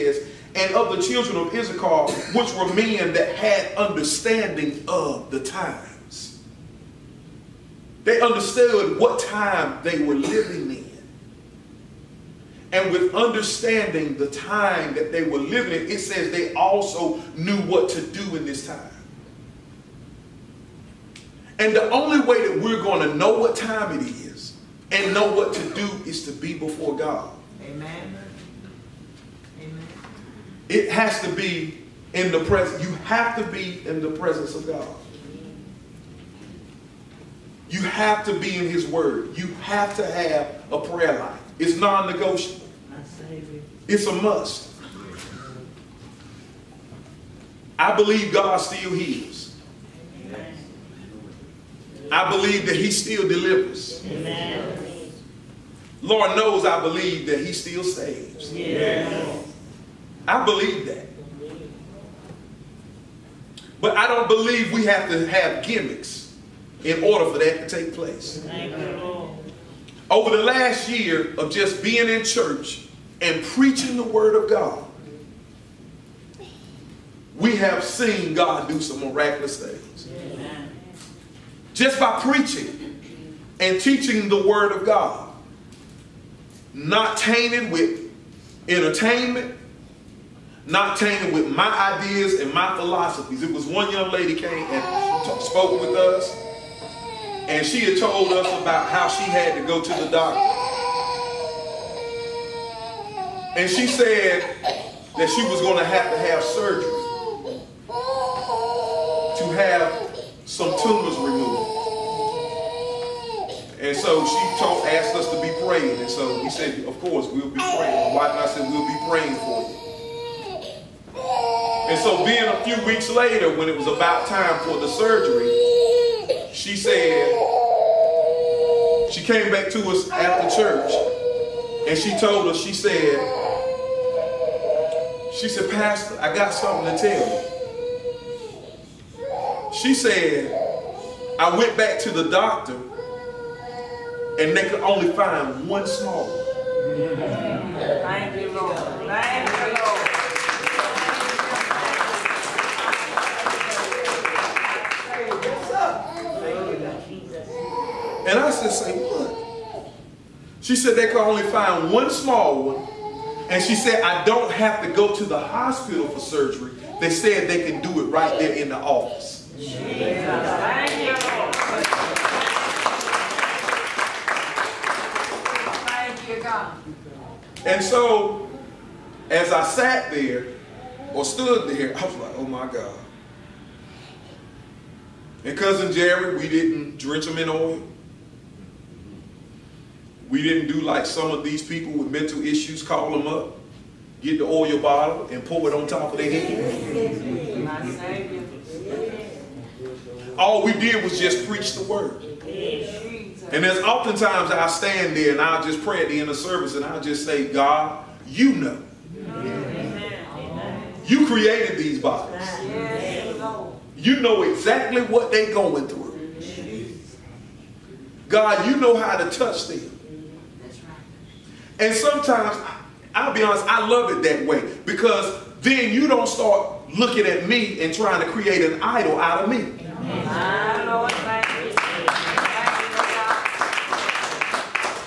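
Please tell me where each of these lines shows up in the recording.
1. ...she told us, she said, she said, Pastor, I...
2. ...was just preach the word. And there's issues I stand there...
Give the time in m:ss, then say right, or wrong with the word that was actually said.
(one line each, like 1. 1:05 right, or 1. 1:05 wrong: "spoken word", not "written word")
1. 2:11 right
2. 3:21 wrong: "oftentimes", not "issues".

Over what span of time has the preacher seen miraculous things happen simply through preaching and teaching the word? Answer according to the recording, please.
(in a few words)
The last year.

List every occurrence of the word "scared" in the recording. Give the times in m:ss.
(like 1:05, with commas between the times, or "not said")
not said.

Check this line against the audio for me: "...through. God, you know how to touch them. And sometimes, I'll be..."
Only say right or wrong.
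right.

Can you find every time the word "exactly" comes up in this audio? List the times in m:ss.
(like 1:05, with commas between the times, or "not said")
3:34.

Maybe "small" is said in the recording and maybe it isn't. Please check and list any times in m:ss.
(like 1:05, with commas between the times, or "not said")
2:25, 2:42.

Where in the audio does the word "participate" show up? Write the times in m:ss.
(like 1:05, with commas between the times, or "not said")
not said.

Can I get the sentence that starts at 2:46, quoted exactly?
They said they can do it right there in the office.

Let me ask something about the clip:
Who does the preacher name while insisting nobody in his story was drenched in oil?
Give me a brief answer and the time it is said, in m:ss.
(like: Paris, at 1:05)
Cousin Jerry, at 3:05.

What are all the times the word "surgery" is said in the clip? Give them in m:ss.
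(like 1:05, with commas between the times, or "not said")
1:46, 2:04, 2:46.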